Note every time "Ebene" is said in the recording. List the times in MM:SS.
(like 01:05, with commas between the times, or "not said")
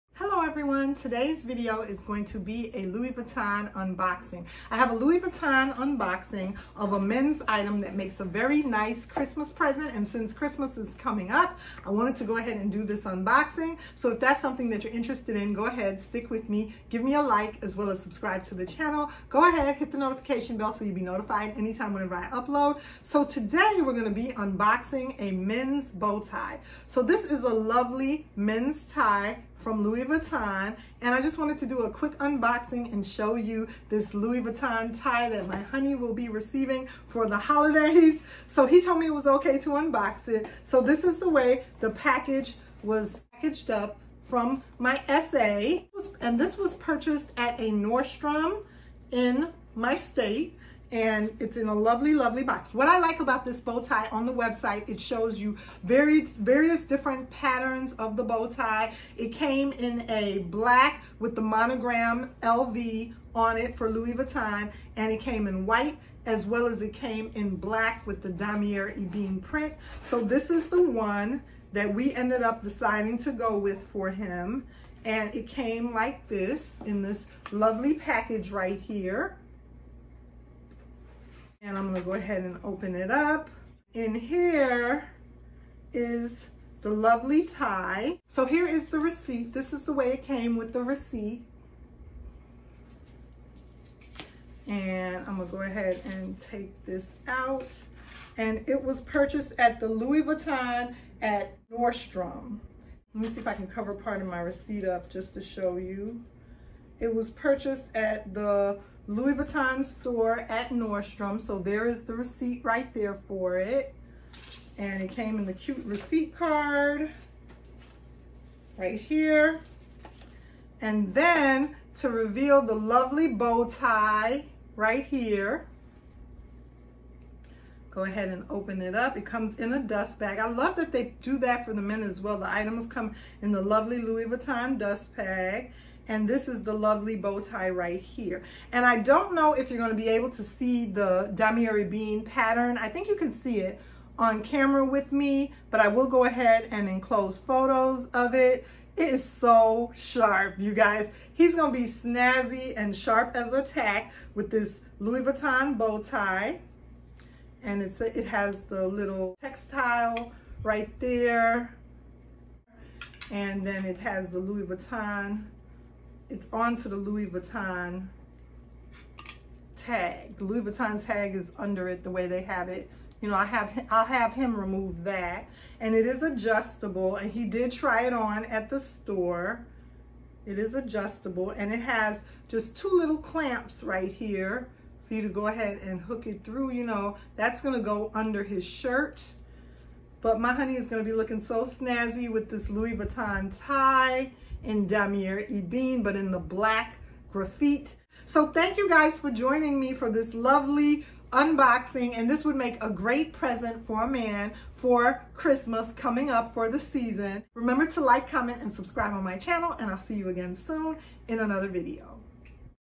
01:08, 02:21, 03:15.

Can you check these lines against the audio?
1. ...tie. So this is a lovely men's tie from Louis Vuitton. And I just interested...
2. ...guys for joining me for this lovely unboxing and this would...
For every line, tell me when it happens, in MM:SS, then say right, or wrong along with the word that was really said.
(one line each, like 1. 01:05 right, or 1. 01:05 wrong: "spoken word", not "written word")
1. 00:26 wrong: "wanted", not "interested"
2. 03:18 right.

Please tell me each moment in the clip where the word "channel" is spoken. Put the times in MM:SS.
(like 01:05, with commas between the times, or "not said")
00:18, 03:29.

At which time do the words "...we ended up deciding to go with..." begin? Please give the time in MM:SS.
01:11.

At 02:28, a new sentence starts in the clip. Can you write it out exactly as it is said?
It is so sharp, you guys.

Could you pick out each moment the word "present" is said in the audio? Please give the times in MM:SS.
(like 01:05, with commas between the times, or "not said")
00:09, 03:23.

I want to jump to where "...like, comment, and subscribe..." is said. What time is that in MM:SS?
03:28.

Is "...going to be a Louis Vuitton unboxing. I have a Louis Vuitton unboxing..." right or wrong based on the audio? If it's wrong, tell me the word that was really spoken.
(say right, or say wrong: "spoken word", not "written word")
right.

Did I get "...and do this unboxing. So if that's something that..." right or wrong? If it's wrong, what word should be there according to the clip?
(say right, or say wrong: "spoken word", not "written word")
right.